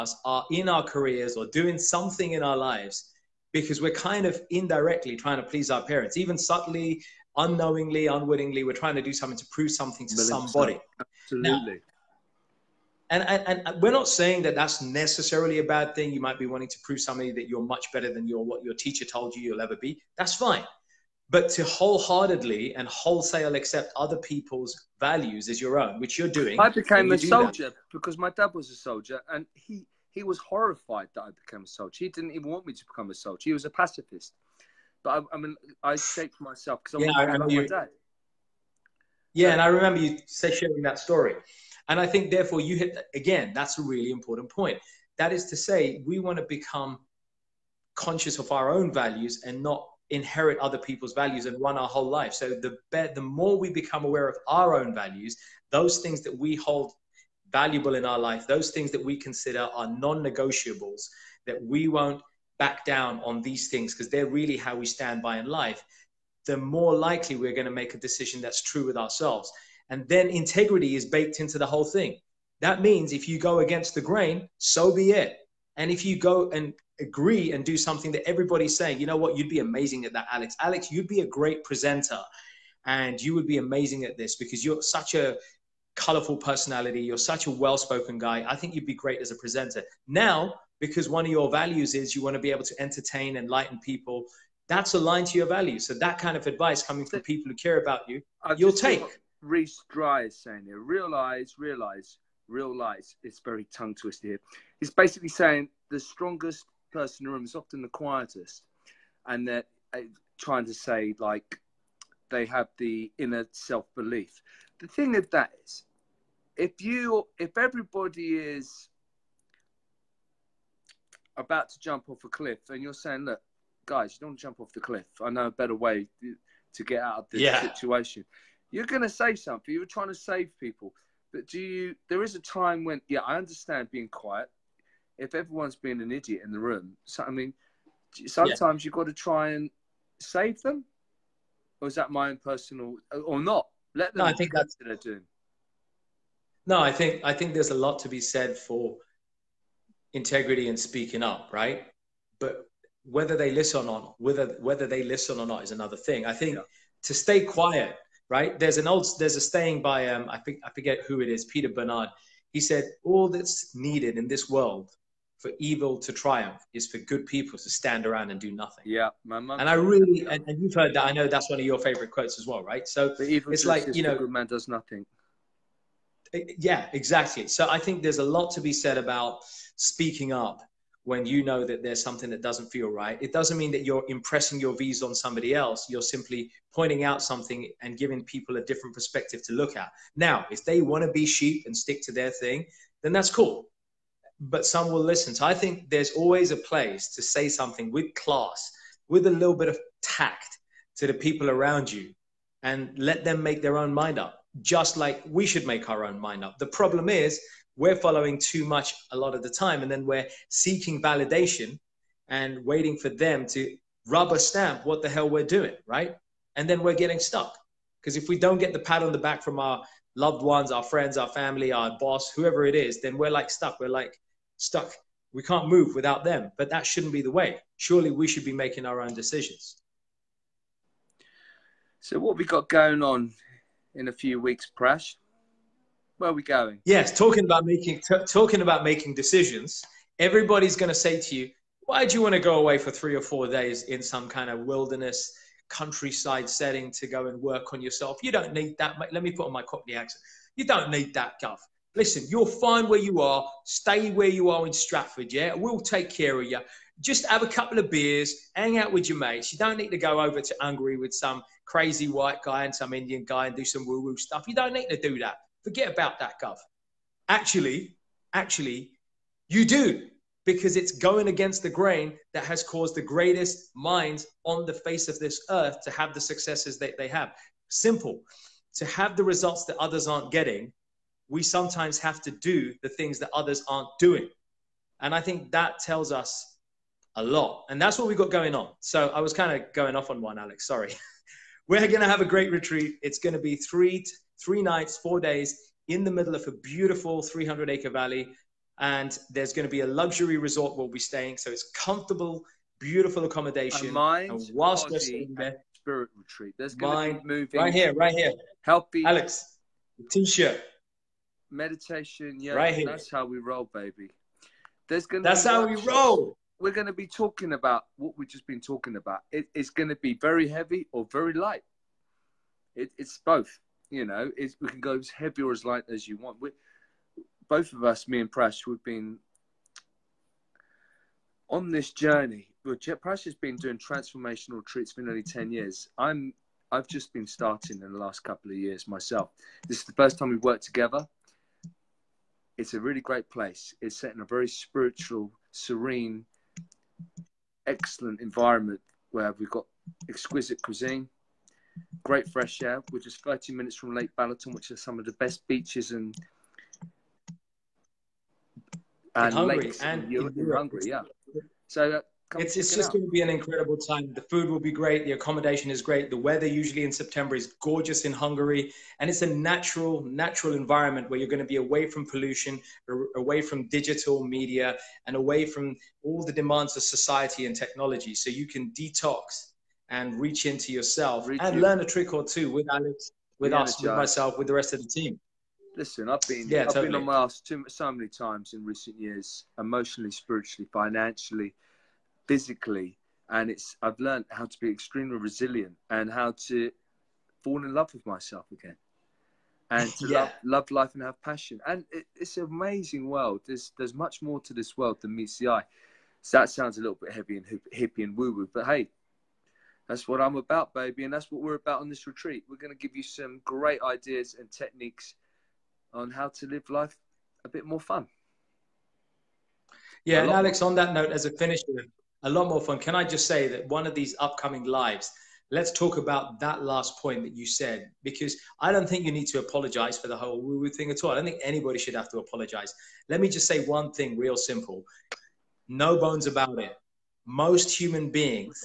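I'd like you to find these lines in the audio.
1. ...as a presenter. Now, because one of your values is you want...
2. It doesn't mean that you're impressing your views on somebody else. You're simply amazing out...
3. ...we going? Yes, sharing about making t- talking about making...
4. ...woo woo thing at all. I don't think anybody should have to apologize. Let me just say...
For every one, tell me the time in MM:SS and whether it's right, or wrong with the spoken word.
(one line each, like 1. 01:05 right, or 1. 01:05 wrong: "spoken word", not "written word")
1. 01:29 right
2. 03:03 wrong: "pointing", not "amazing"
3. 03:56 wrong: "talking", not "sharing"
4. 07:10 right.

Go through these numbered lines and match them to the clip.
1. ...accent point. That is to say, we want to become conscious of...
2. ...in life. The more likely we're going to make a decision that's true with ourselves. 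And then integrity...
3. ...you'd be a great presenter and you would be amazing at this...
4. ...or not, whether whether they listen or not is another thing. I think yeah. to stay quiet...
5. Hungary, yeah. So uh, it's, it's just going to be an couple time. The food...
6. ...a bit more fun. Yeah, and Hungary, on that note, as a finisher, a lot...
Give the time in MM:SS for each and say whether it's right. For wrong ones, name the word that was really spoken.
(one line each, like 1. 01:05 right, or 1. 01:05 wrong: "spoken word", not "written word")
1. 00:44 wrong: "important", not "accent"
2. 01:05 right
3. 01:20 right
4. 02:33 right
5. 06:00 wrong: "incredible", not "couple"
6. 06:57 wrong: "Alex", not "Hungary".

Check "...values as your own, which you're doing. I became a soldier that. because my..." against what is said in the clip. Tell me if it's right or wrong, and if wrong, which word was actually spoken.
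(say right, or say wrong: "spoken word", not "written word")
right.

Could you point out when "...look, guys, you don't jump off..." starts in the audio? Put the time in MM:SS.
02:03.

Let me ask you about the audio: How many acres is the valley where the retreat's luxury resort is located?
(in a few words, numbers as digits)
300.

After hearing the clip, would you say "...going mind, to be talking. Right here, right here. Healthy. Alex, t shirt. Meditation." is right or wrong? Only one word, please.
wrong.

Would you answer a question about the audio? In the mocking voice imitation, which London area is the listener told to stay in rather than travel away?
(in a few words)
Stratford.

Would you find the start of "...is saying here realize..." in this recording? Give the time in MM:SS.
01:40.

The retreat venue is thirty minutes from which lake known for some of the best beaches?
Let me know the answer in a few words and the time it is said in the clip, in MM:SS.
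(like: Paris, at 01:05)
Lake Balaton, at 05:53.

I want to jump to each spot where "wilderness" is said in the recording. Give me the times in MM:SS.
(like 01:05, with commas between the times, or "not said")
04:04.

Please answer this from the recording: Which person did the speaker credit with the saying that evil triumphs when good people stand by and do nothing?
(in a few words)
Peter Bernard.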